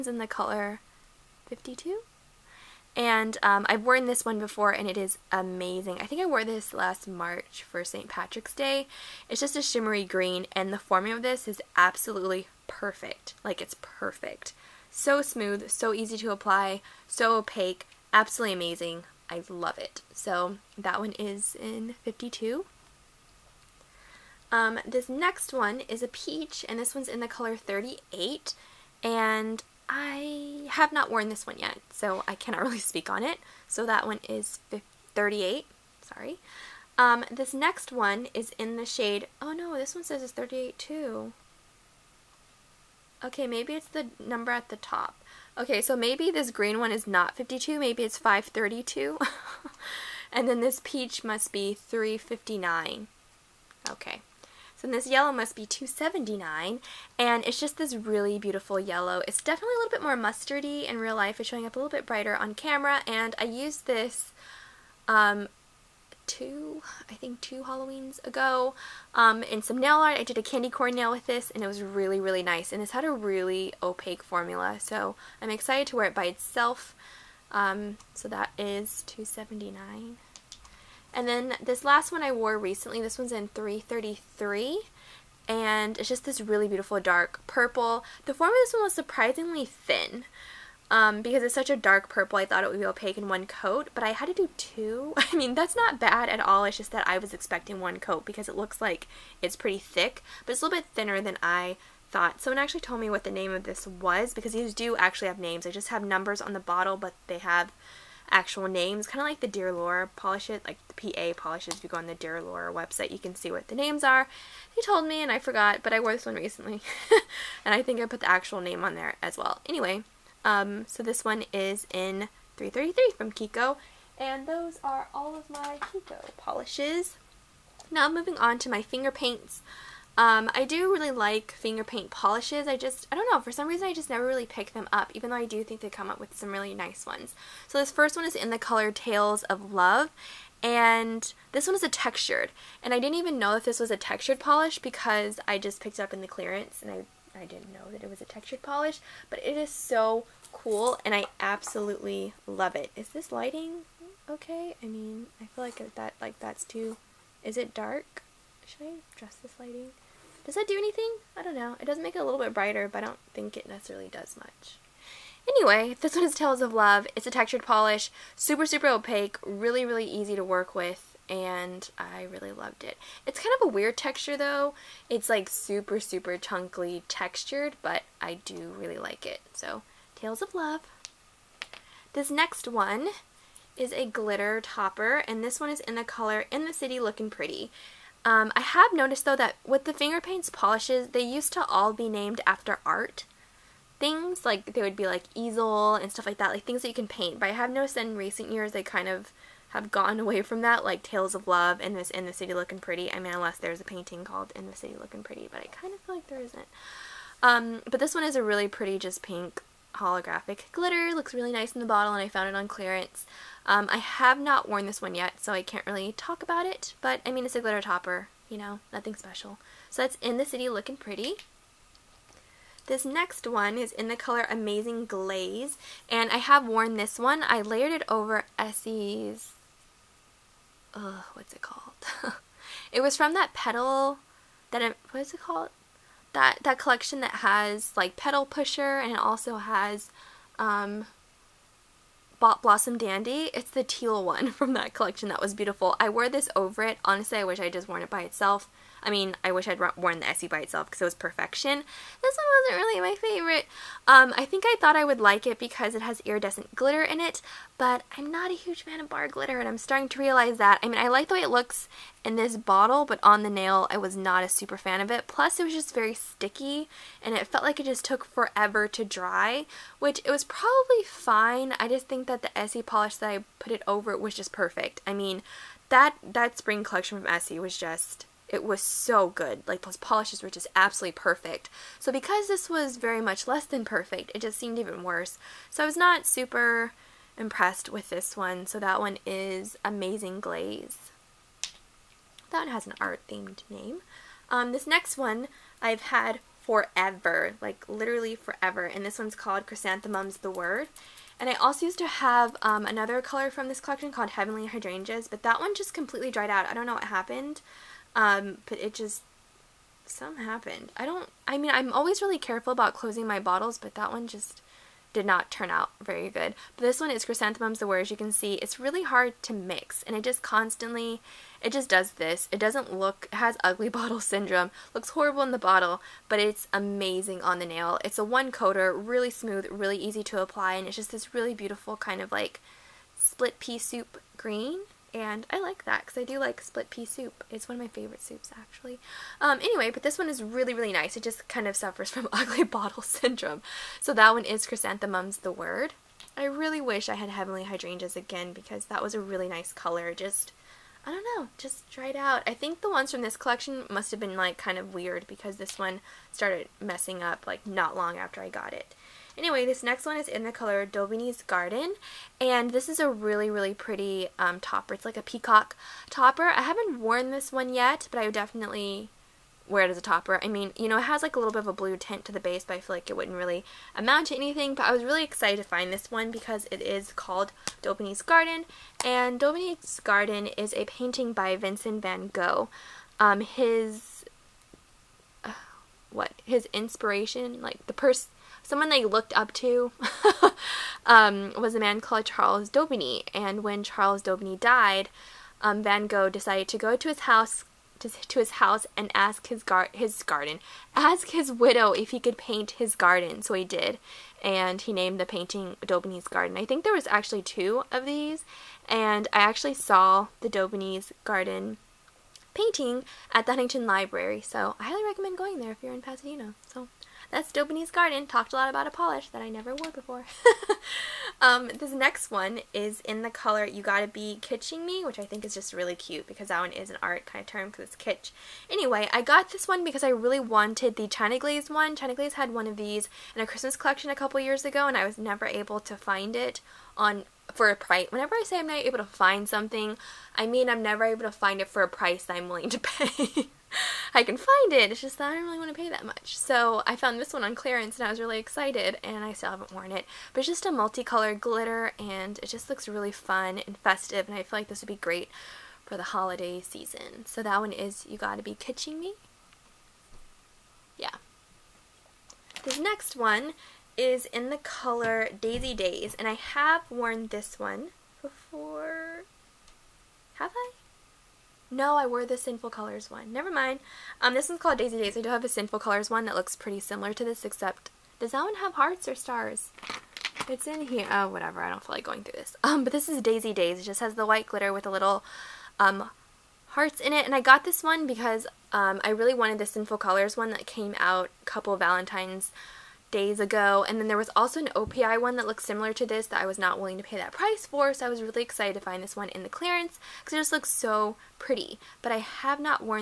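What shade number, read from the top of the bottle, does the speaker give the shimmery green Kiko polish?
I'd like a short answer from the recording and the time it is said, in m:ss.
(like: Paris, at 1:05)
532, at 0:48.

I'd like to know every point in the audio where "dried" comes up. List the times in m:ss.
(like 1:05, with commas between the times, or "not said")
5:06, 5:51.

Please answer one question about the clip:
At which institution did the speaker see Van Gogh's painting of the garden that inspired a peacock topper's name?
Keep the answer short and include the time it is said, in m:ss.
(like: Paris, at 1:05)
Huntington Library, at 6:53.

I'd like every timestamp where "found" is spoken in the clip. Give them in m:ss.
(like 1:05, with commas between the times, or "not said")
3:32, 7:26.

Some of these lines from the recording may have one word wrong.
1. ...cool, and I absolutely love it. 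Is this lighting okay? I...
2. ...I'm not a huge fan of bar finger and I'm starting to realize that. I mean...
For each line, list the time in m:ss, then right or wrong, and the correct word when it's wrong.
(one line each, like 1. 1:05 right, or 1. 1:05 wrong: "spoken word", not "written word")
1. 2:30 right
2. 4:18 wrong: "glitter", not "finger".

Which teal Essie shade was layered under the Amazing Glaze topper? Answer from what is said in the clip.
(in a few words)
Blossom Dandy.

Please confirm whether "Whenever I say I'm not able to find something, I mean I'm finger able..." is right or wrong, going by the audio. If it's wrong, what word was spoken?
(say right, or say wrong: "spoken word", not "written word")
wrong: "never", not "finger".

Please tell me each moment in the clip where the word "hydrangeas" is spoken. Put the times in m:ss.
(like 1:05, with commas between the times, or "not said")
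5:04, 5:47.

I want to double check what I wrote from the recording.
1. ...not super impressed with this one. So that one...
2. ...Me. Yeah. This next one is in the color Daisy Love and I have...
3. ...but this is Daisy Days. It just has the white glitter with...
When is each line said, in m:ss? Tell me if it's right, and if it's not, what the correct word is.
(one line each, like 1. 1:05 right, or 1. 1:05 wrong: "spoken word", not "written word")
1. 4:45 right
2. 7:38 wrong: "Days", not "Love"
3. 8:02 right.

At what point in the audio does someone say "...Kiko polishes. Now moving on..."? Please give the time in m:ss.
2:05.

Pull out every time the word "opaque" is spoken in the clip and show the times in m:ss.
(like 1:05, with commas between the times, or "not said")
0:17, 1:13, 1:32, 2:48.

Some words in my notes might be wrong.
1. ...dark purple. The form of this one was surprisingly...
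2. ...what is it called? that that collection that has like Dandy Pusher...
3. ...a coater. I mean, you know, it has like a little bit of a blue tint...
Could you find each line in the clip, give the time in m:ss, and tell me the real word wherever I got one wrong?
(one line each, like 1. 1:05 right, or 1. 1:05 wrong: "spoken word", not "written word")
1. 1:26 right
2. 3:55 wrong: "Petal", not "Dandy"
3. 6:09 wrong: "topper", not "coater".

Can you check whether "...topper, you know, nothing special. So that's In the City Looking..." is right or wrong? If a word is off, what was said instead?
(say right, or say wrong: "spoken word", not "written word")
right.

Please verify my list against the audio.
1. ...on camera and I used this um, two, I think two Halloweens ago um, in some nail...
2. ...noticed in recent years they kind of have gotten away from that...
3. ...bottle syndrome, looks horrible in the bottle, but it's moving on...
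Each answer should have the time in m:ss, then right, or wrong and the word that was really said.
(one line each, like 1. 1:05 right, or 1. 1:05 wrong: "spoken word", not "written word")
1. 1:02 right
2. 3:17 right
3. 5:23 wrong: "amazing", not "moving".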